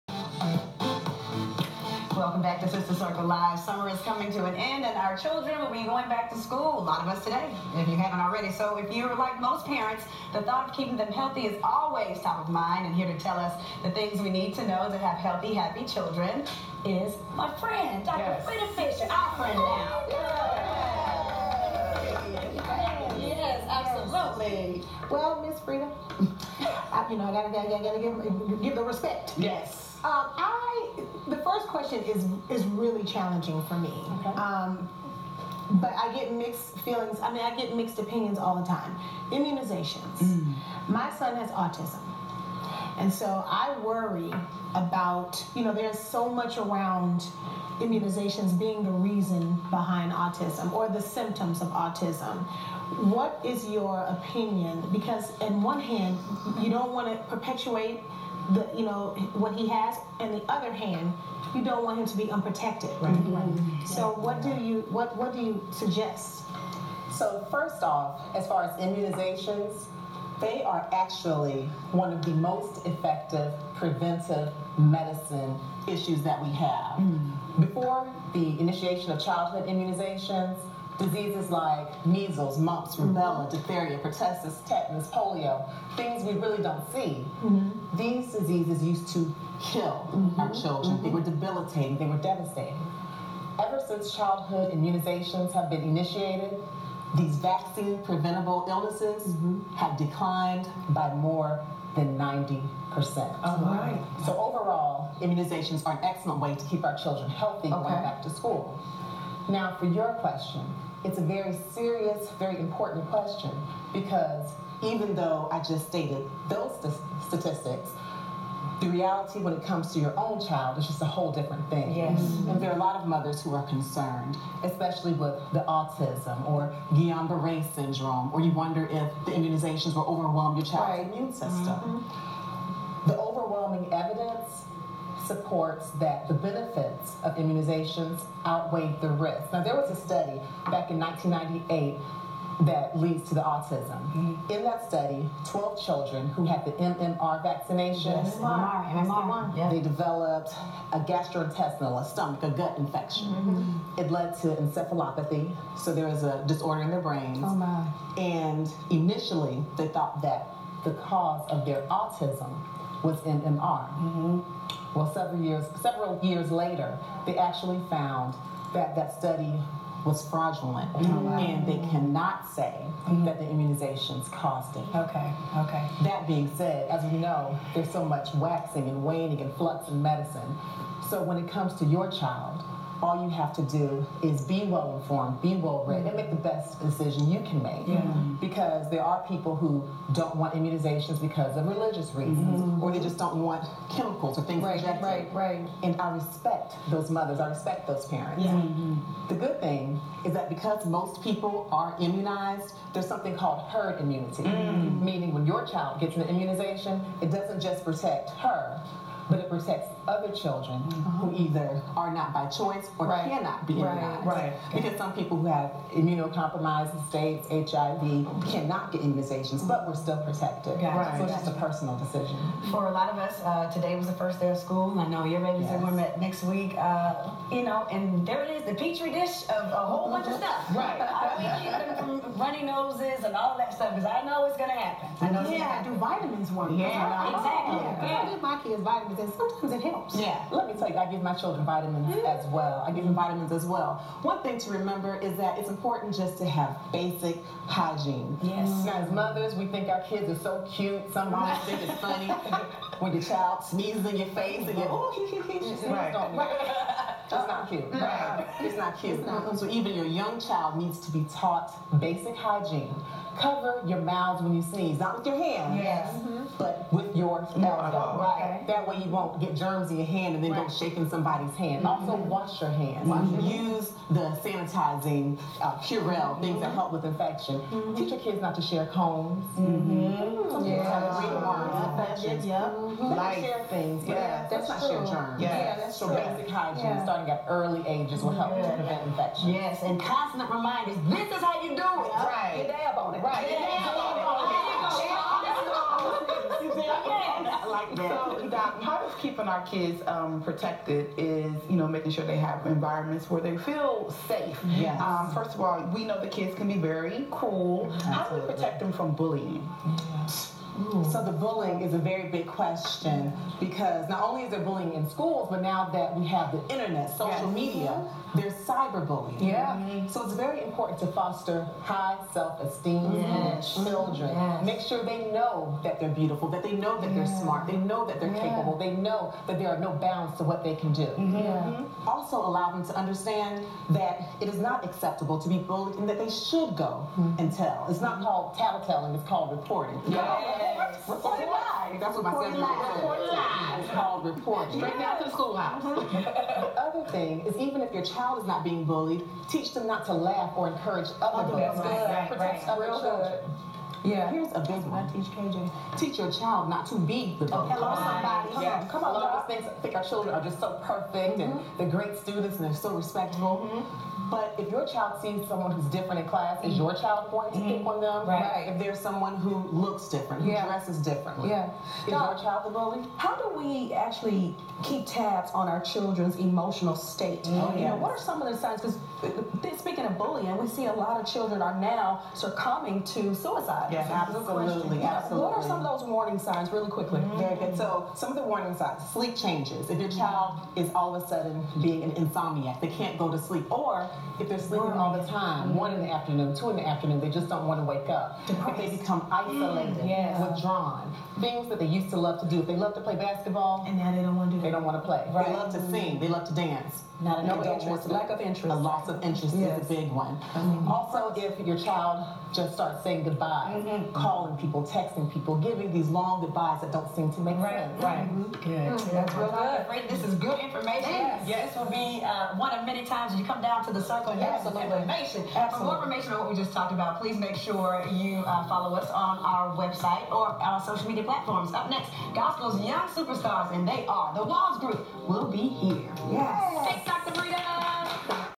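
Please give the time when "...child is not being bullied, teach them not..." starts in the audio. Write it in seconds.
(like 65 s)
348 s.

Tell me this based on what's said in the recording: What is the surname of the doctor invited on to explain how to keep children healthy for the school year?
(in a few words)
Fisher.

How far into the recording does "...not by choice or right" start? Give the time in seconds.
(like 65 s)
212 s.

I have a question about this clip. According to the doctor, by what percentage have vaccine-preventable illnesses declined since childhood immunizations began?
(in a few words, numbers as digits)
90%.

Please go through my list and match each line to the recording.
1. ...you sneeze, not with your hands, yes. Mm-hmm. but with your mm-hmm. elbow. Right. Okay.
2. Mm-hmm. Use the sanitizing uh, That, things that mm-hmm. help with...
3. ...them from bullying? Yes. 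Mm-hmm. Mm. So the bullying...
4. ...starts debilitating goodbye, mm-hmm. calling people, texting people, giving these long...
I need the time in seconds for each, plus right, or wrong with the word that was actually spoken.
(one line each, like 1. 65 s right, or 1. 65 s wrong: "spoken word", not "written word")
1. 264 s right
2. 273 s wrong: "Purell", not "That"
3. 308 s right
4. 412 s wrong: "saying", not "debilitating".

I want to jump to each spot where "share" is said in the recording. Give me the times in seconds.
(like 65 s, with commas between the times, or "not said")
278 s, 285 s.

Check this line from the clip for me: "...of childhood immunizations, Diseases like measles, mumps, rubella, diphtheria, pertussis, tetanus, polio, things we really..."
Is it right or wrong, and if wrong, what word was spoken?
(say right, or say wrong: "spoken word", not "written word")
right.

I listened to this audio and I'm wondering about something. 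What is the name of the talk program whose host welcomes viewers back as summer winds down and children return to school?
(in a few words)
Sister Circle Live.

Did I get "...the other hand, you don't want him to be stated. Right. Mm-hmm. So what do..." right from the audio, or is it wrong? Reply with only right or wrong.
wrong.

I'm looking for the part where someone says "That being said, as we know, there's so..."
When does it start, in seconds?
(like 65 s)
176 s.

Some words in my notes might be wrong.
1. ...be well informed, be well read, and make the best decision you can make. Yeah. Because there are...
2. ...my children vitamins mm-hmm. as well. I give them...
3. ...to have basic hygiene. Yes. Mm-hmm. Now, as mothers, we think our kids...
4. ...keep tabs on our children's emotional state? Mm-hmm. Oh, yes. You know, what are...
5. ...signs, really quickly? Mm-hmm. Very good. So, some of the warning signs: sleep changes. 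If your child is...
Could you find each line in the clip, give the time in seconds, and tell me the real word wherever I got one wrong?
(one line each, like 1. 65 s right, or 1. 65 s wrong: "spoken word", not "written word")
1. 184 s right
2. 241 s right
3. 246 s right
4. 374 s right
5. 386 s right.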